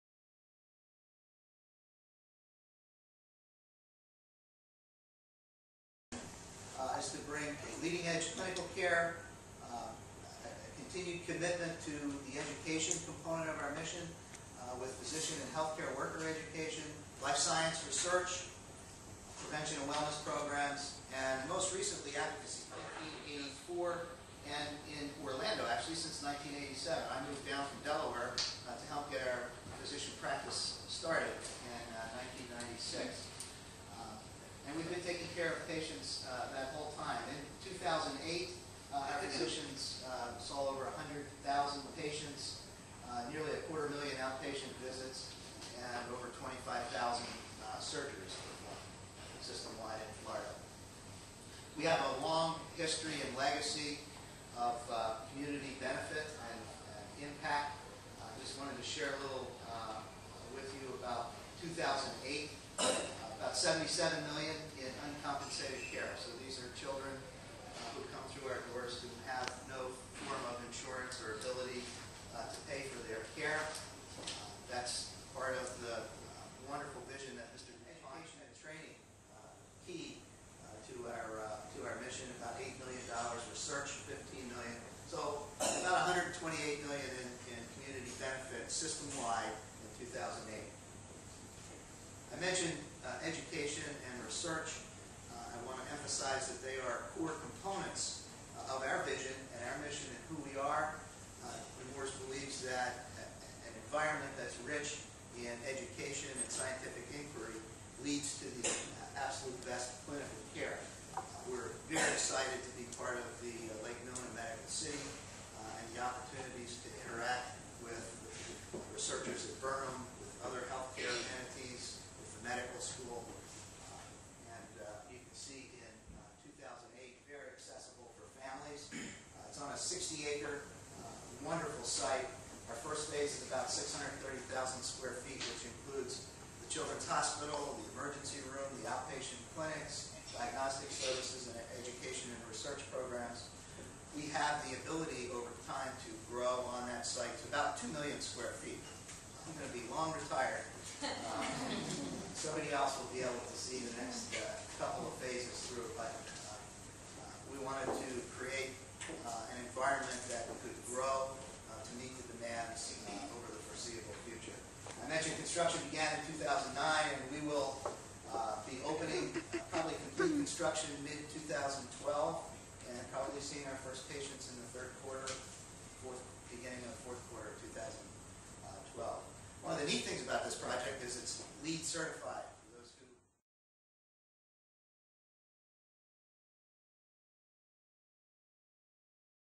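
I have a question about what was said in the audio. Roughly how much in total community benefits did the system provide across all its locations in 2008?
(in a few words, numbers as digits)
$128 million.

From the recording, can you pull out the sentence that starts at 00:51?
We have a long history and legacy of uh, community benefit and, and impact.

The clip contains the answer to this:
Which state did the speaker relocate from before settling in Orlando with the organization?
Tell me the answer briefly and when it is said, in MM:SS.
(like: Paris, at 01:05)
Delaware, at 00:27.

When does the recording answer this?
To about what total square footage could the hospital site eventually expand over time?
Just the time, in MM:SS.
02:27.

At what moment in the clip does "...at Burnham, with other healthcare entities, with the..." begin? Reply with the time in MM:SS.
01:59.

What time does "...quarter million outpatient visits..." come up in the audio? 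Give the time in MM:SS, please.
00:43.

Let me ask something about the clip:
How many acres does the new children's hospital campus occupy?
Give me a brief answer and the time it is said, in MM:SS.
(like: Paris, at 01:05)
60, at 02:09.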